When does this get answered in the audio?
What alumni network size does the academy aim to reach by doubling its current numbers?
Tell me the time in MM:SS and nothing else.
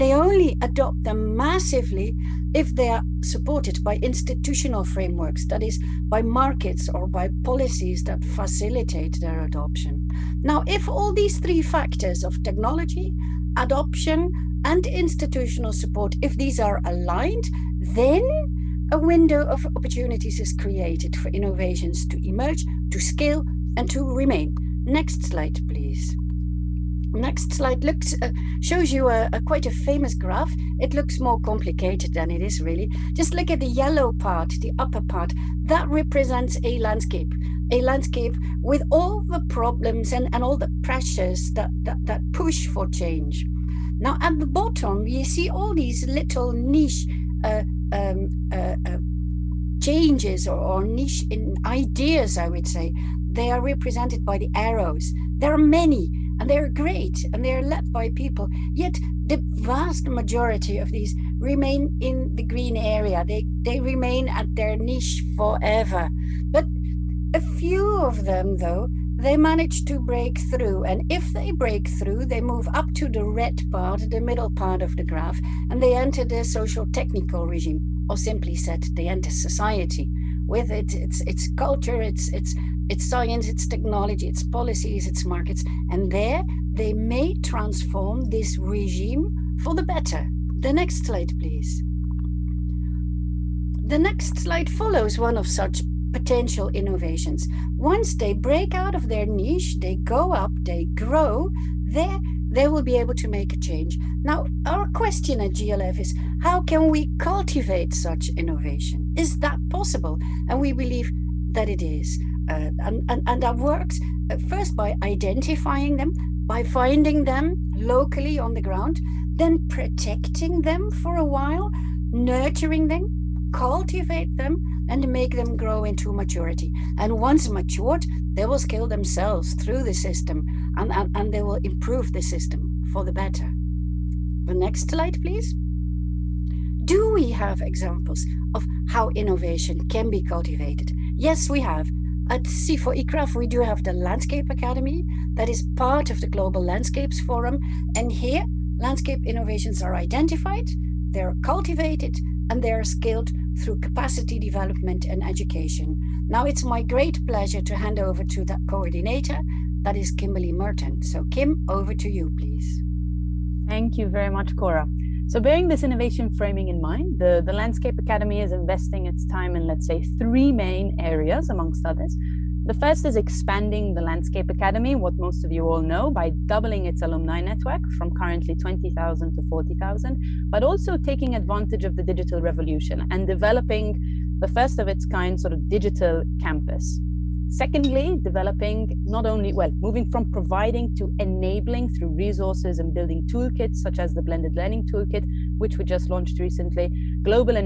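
02:59.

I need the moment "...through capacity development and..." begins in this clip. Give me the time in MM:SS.
02:33.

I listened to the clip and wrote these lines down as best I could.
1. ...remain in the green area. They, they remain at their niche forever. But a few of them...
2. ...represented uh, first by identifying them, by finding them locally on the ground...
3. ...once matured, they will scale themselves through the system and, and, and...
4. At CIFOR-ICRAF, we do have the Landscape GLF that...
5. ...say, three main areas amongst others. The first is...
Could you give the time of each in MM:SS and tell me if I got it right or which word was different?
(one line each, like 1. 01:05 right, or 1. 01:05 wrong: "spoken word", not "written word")
1. 01:01 right
2. 01:53 wrong: "worked", not "represented"
3. 02:07 right
4. 02:22 wrong: "Academy", not "GLF"
5. 02:49 right.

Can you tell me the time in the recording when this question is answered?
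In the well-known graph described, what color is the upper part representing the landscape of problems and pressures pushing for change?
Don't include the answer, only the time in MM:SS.
00:33.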